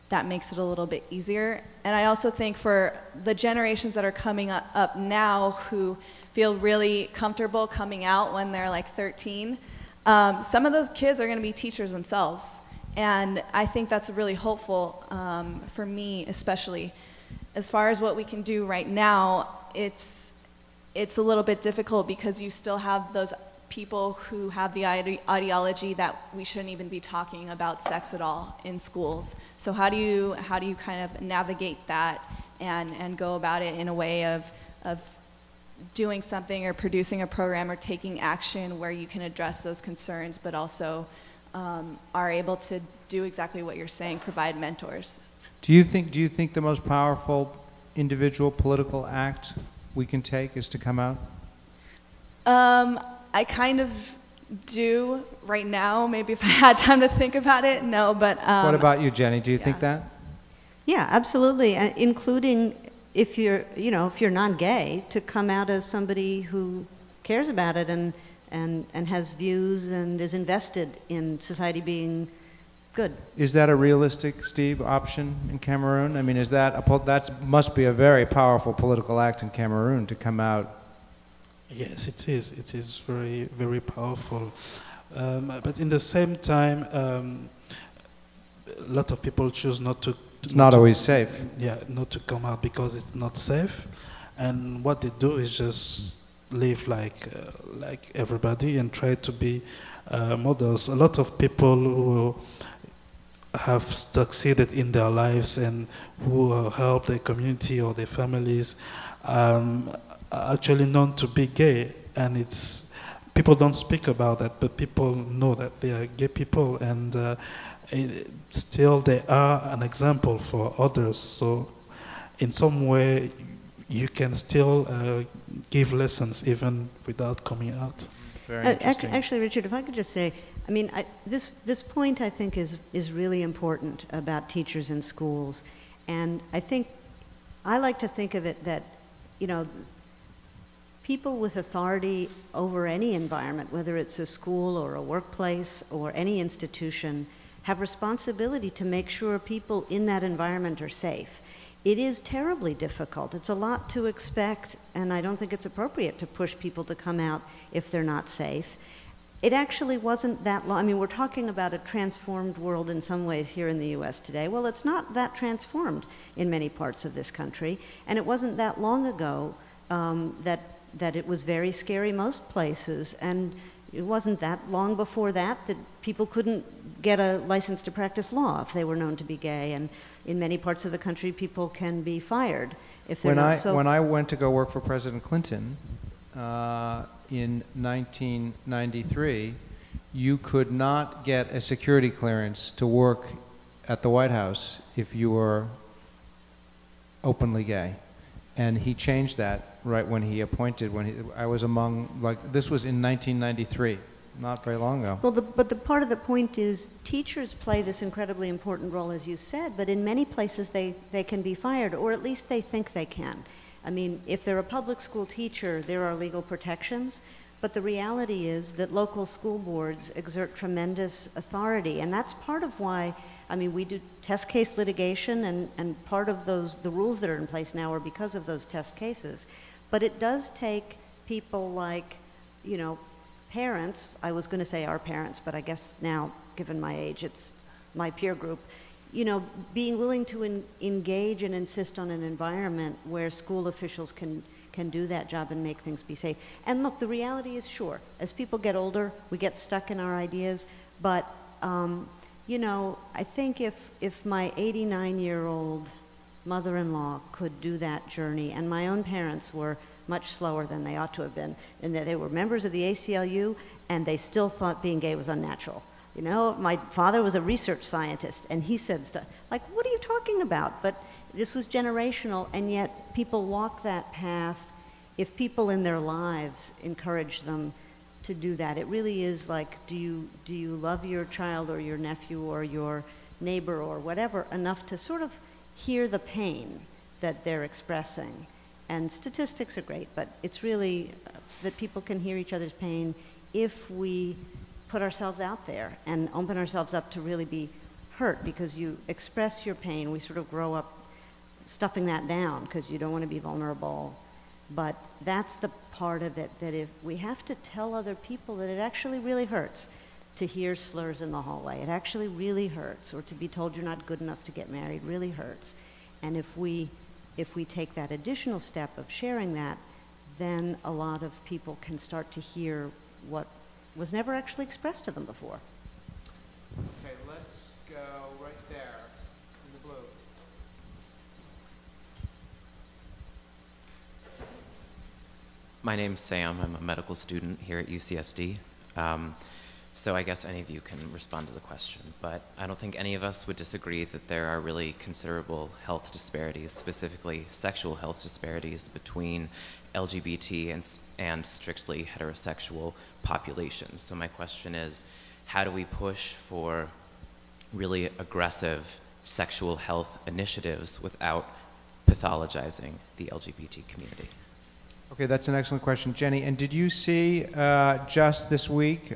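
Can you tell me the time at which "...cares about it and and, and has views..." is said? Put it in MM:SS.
01:07.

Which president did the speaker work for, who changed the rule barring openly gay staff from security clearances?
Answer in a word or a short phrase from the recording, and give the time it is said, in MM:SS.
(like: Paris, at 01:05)
President Clinton, at 03:04.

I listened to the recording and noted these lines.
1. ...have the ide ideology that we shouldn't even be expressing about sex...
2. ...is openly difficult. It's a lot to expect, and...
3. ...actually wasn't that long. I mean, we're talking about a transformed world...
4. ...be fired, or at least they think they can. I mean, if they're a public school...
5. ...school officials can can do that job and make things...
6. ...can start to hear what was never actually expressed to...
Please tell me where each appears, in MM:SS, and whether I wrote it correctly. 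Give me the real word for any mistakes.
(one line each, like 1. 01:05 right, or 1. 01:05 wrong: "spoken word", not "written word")
1. 00:24 wrong: "talking", not "expressing"
2. 02:31 wrong: "terribly", not "openly"
3. 02:39 right
4. 03:31 right
5. 04:03 right
6. 05:21 right.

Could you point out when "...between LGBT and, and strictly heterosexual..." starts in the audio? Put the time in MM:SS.
05:48.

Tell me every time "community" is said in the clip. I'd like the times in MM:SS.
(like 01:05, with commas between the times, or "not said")
01:47, 06:03.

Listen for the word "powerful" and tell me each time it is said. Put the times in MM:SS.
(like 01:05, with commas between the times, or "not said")
00:46, 01:18, 01:23.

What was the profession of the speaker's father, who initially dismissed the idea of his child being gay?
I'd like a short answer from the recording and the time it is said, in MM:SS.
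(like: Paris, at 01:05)
research scientist, at 04:27.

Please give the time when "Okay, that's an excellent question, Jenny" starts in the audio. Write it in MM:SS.
06:05.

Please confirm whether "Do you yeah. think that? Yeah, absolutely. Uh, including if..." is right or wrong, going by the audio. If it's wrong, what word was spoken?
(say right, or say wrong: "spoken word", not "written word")
right.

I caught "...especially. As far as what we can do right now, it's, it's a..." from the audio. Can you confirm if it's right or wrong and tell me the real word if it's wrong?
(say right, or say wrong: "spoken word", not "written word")
right.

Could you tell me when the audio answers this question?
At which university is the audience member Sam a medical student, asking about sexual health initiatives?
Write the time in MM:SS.
05:37.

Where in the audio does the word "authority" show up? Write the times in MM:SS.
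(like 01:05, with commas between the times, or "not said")
02:21, 03:41.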